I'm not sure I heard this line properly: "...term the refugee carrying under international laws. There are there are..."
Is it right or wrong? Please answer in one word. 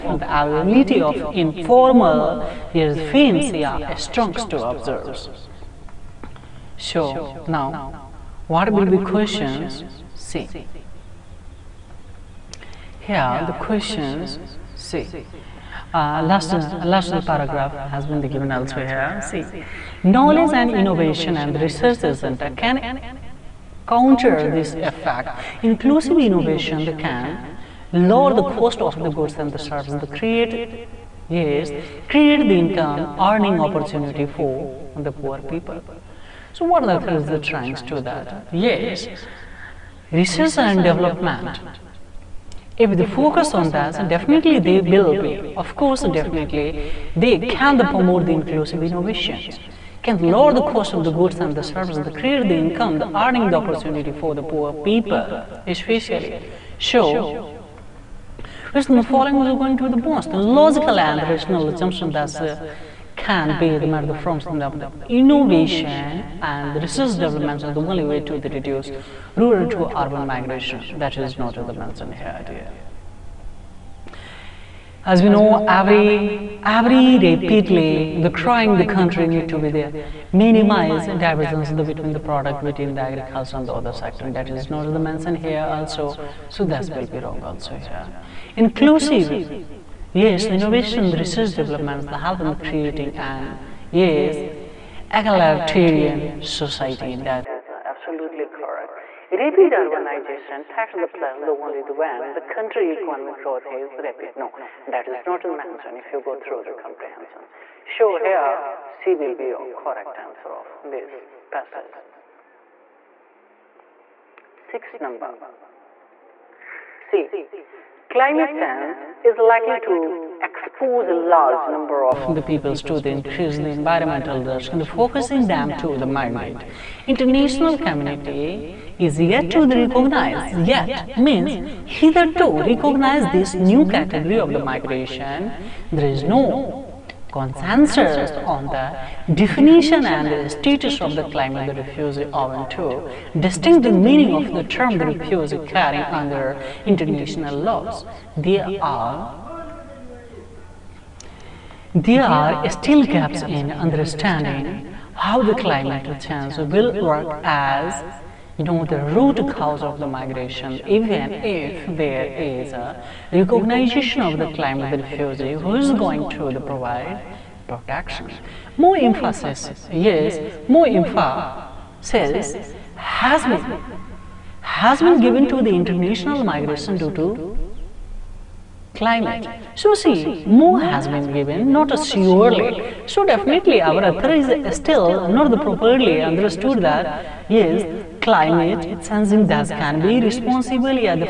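right.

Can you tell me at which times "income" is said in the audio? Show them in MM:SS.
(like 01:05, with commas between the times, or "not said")
00:32, 00:52.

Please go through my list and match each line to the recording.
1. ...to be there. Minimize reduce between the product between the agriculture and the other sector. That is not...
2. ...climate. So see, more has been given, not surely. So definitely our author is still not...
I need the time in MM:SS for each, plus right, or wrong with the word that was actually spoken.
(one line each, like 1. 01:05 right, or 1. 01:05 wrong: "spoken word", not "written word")
1. 01:19 wrong: "divergence", not "reduce"
2. 02:58 right.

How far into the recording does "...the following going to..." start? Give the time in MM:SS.
00:58.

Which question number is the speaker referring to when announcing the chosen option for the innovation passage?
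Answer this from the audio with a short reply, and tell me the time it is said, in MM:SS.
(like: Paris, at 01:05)
Six, at 01:54.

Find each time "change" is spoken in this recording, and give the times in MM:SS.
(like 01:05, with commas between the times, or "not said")
01:58, 02:36.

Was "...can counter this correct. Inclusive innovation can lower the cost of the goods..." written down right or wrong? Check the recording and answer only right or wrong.
wrong.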